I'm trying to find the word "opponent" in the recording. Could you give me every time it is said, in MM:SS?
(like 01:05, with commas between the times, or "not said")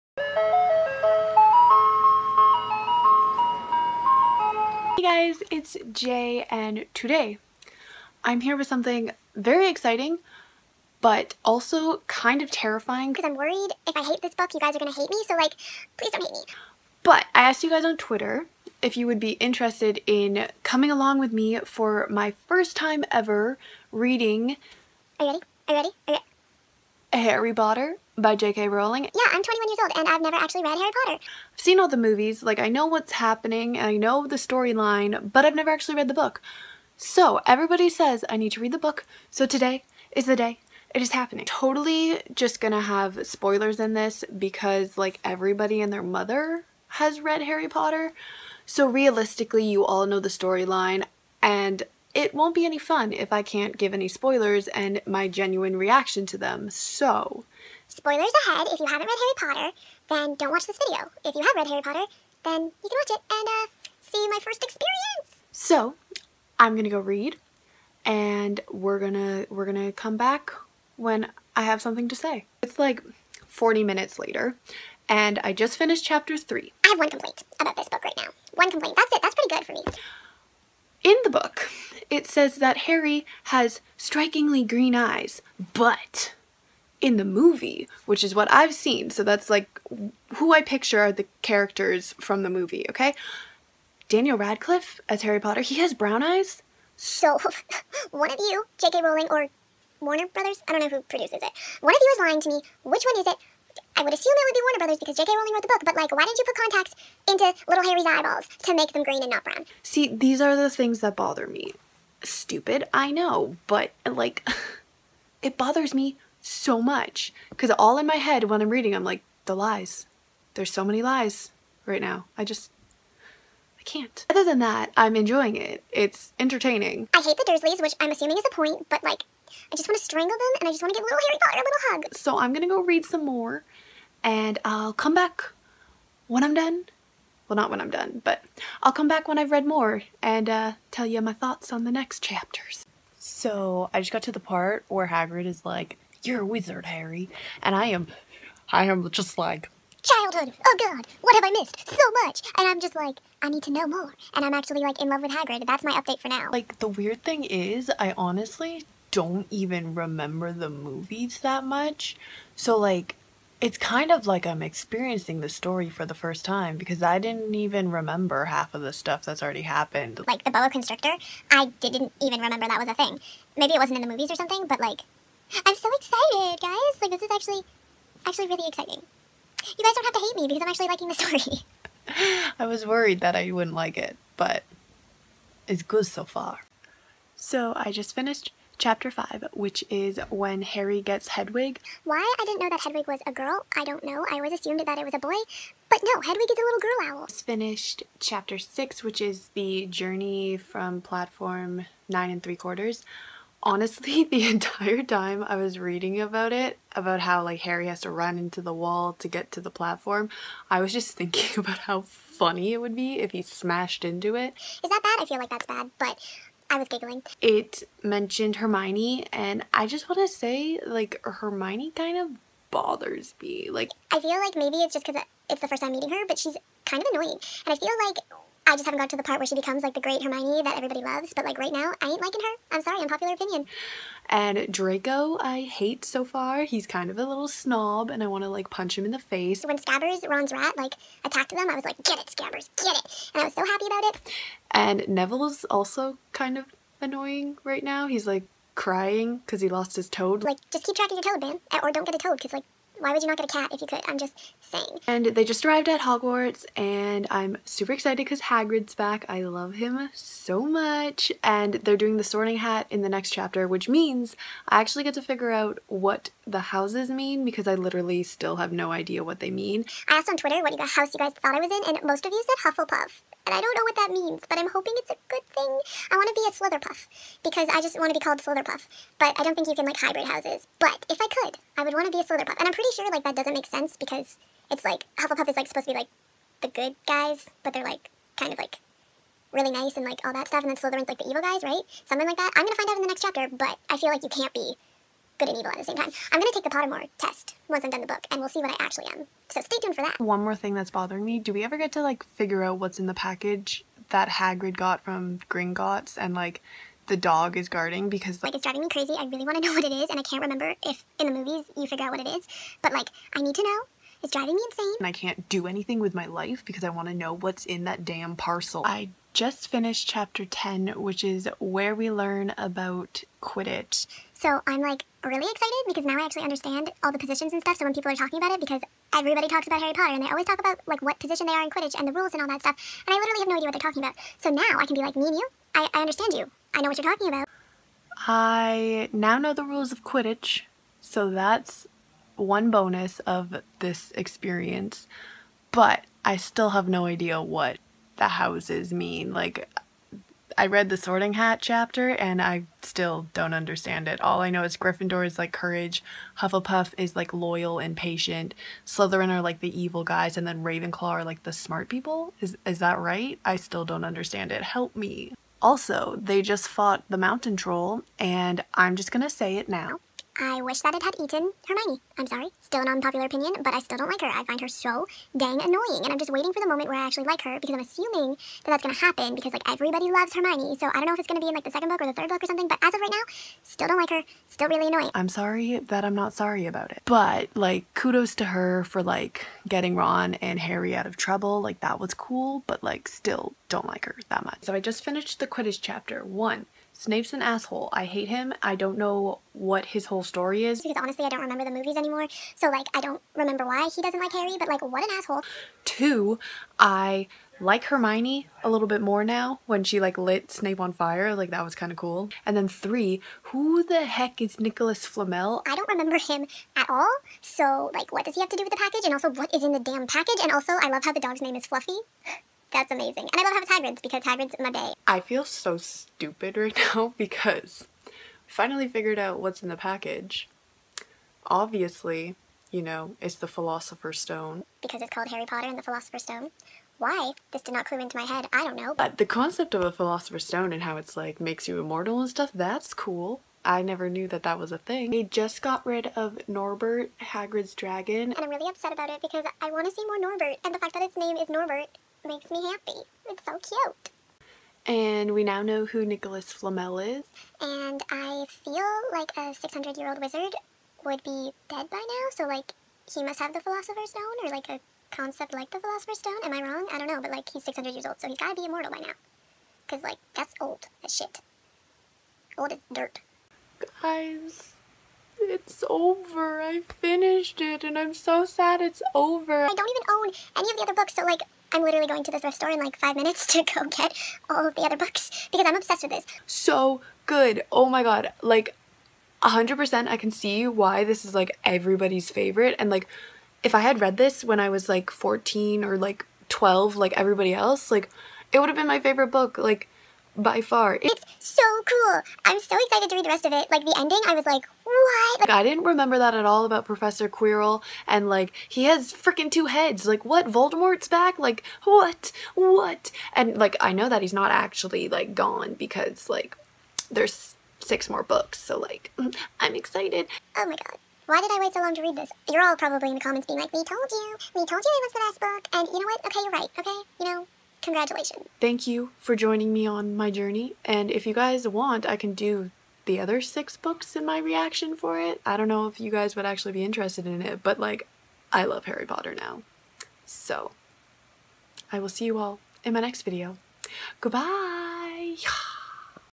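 not said.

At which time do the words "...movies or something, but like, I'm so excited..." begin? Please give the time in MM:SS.
02:54.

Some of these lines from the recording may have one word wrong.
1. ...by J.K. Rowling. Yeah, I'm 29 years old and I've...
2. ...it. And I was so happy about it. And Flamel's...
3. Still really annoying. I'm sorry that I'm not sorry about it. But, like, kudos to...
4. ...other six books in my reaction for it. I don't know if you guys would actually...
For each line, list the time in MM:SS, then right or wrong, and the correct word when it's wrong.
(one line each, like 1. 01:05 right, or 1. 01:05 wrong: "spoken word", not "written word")
1. 00:28 wrong: "21", not "29"
2. 04:02 wrong: "Neville", not "Flamel"
3. 06:24 right
4. 08:53 right.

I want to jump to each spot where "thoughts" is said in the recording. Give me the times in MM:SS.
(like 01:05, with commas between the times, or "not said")
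02:21, 04:31.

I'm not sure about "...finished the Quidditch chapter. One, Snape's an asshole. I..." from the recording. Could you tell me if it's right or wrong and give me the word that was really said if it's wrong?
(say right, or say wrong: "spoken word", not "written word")
right.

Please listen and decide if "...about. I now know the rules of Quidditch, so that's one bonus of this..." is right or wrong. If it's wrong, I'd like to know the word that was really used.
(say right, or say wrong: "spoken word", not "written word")
right.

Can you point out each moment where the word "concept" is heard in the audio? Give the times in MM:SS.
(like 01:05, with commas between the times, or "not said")
07:19, 07:45.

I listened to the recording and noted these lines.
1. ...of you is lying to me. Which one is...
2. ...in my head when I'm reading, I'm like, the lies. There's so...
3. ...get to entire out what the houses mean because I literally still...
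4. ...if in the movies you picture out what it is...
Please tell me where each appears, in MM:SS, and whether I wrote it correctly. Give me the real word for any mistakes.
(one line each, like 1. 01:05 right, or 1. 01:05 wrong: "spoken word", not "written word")
1. 01:41 right
2. 01:57 right
3. 04:25 wrong: "figure", not "entire"
4. 05:10 wrong: "figure", not "picture".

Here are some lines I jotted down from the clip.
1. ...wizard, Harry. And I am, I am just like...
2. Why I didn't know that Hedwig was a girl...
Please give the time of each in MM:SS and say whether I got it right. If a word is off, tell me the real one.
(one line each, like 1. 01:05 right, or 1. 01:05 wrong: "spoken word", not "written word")
1. 02:26 right
2. 03:12 right.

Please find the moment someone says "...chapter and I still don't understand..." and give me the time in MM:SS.
05:51.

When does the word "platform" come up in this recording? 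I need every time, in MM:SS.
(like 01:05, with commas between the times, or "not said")
03:20, 03:29.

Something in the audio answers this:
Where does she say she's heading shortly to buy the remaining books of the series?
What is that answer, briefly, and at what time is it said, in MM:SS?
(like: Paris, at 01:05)
the thrift store, at 08:02.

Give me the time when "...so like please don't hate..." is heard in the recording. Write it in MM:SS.
00:15.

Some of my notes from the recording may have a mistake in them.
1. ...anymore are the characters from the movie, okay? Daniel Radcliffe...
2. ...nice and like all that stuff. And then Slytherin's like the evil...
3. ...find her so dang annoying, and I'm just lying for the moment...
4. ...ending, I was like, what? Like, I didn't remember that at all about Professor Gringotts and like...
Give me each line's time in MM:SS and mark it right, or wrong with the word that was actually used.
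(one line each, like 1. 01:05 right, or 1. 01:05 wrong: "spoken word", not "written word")
1. 01:30 wrong: "picture", not "anymore"
2. 04:49 right
3. 06:14 wrong: "waiting", not "lying"
4. 08:23 wrong: "Quirrell", not "Gringotts".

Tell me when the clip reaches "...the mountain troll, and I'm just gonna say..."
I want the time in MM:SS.
06:07.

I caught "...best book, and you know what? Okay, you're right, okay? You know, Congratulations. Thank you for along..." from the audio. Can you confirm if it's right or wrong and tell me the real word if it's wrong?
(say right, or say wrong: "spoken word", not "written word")
wrong: "joining", not "along".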